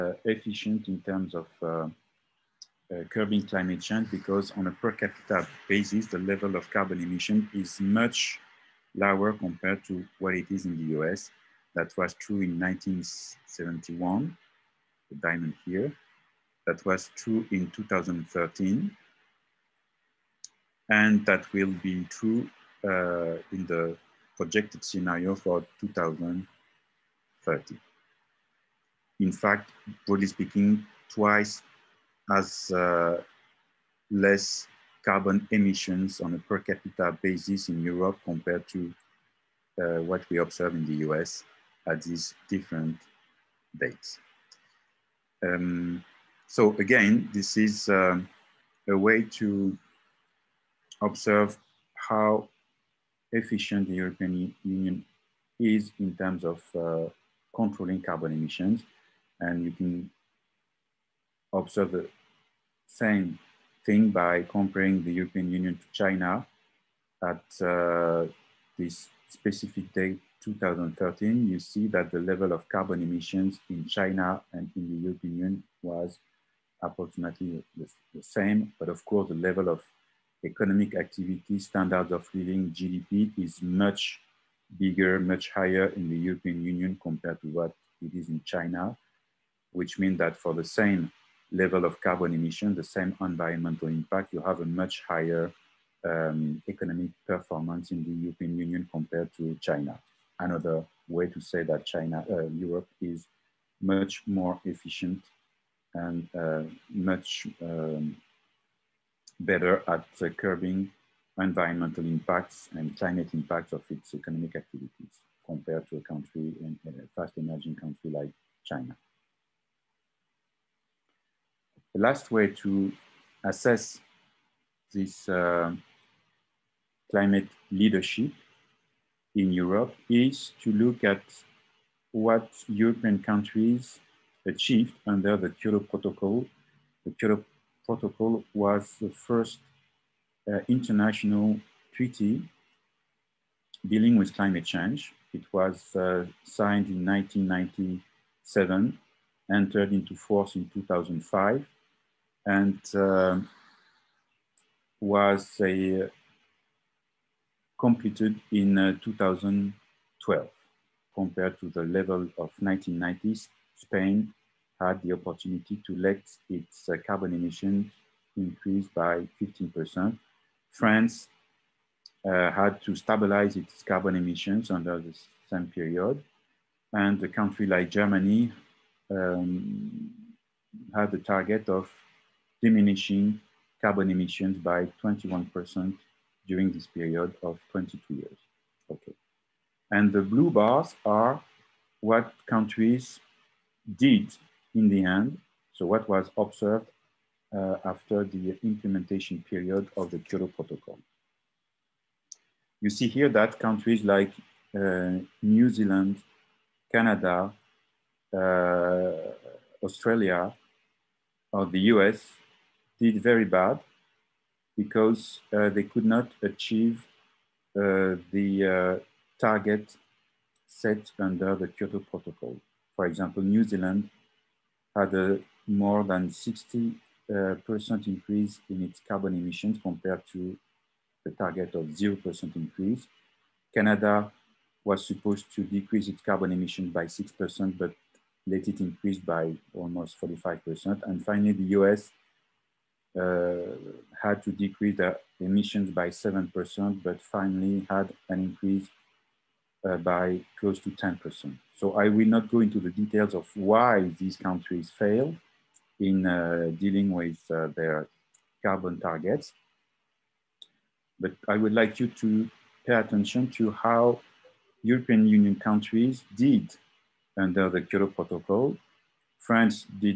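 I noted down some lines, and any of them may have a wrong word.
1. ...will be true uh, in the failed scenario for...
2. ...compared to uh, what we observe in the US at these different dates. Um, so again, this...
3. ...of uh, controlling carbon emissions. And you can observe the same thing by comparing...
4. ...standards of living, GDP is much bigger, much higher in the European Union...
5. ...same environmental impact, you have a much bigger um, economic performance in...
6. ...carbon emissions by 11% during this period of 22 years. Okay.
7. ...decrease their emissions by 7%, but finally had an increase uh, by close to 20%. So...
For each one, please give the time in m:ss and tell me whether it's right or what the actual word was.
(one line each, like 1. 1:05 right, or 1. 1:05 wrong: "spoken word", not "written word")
1. 0:21 wrong: "projected", not "failed"
2. 0:38 right
3. 0:56 right
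4. 1:21 right
5. 1:32 wrong: "higher", not "bigger"
6. 3:03 wrong: "21", not "11"
7. 4:04 wrong: "10", not "20".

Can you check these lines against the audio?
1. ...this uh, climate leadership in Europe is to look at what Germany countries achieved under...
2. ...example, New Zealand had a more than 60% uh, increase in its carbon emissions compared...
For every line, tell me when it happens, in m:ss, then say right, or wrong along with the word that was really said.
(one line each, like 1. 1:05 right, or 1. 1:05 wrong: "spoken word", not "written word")
1. 2:04 wrong: "European", not "Germany"
2. 3:43 right.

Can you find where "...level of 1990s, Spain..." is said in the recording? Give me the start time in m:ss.
2:41.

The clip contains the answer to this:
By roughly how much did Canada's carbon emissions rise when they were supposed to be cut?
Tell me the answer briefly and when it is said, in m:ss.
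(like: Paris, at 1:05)
almost 45%, at 3:59.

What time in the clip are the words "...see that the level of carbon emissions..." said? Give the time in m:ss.
1:11.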